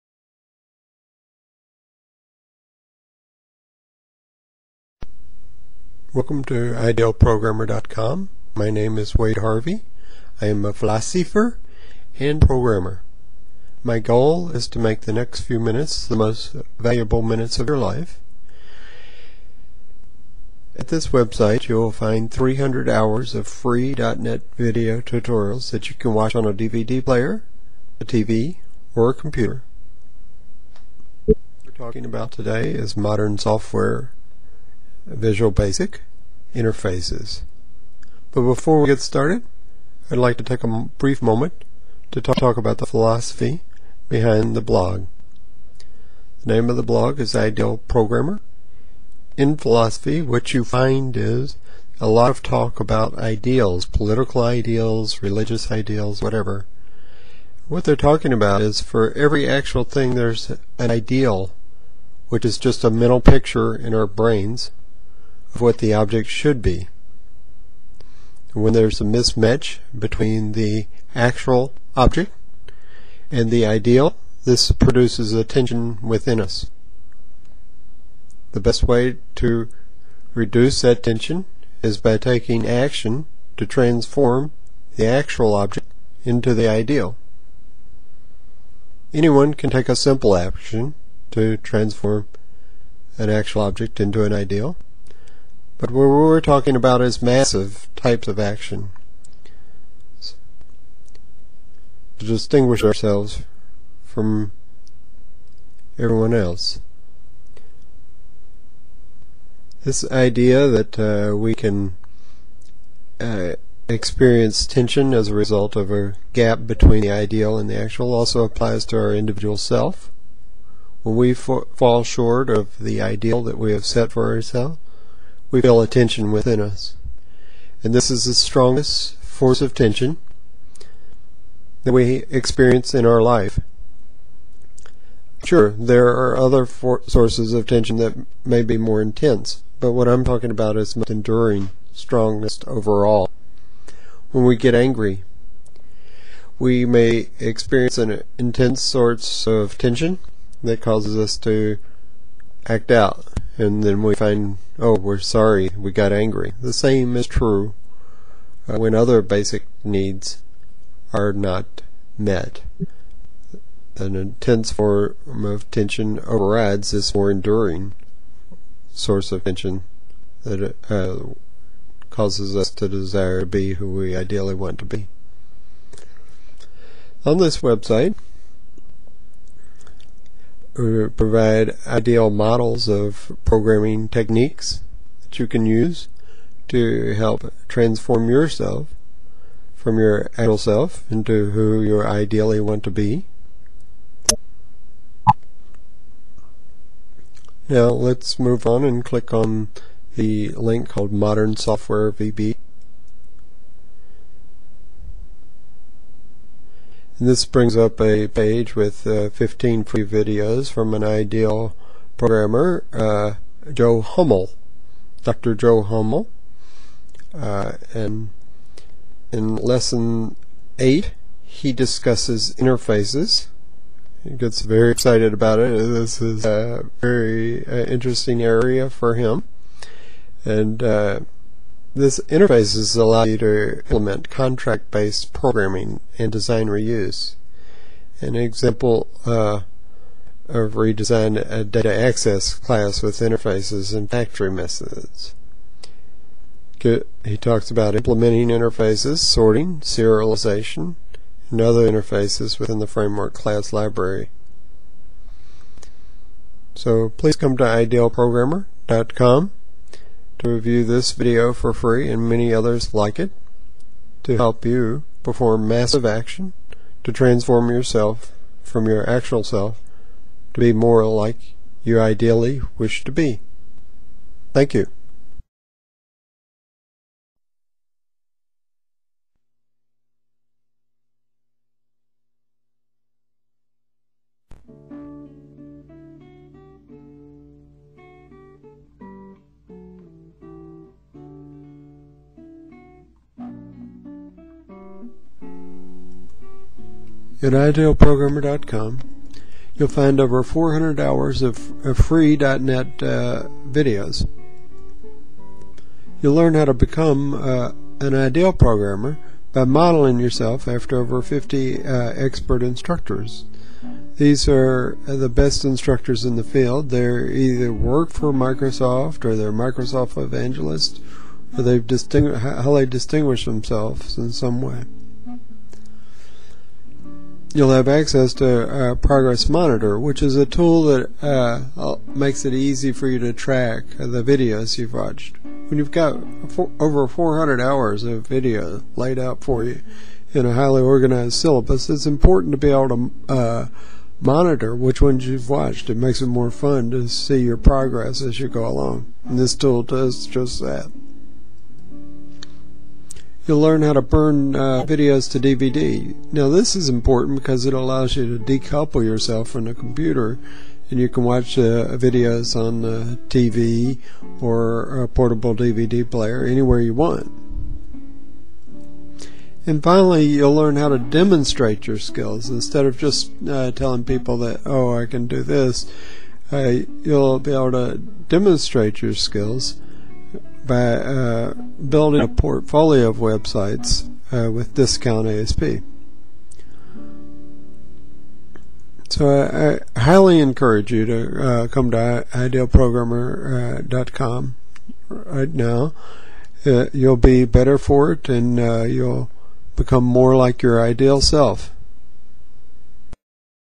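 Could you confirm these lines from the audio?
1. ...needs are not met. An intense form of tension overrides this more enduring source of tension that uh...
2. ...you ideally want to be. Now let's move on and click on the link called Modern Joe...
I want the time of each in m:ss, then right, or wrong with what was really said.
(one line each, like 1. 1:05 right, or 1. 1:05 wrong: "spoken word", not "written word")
1. 2:39 right
2. 3:11 wrong: "Software", not "Joe".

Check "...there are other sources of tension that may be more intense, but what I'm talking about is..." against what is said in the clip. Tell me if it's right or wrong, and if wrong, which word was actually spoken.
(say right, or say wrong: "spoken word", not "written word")
right.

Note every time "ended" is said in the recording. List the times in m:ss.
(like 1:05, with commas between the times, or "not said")
not said.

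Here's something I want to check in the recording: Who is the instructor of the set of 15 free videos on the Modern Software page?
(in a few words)
Dr. Joe Hummel.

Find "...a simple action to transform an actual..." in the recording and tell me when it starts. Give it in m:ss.
1:29.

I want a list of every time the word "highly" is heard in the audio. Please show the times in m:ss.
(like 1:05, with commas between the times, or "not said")
5:40, 6:30.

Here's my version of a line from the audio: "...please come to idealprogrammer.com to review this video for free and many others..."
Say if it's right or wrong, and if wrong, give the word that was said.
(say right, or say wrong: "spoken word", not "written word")
right.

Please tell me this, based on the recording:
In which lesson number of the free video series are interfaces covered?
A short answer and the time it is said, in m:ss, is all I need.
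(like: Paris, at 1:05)
8, at 3:40.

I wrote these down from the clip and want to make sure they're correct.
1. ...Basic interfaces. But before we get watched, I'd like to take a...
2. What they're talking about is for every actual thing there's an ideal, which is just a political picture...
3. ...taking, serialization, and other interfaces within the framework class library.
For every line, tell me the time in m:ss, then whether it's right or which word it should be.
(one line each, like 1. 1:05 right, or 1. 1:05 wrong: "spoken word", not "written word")
1. 0:35 wrong: "started", not "watched"
2. 0:57 wrong: "mental", not "political"
3. 4:09 wrong: "sorting", not "taking".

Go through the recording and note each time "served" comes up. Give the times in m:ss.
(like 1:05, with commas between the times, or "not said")
not said.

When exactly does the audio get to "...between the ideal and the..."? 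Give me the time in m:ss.
1:56.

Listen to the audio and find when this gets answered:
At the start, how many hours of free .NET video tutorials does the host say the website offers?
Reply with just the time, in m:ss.
0:22.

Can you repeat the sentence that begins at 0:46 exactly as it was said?
The name of the blog is Ideal Programmer.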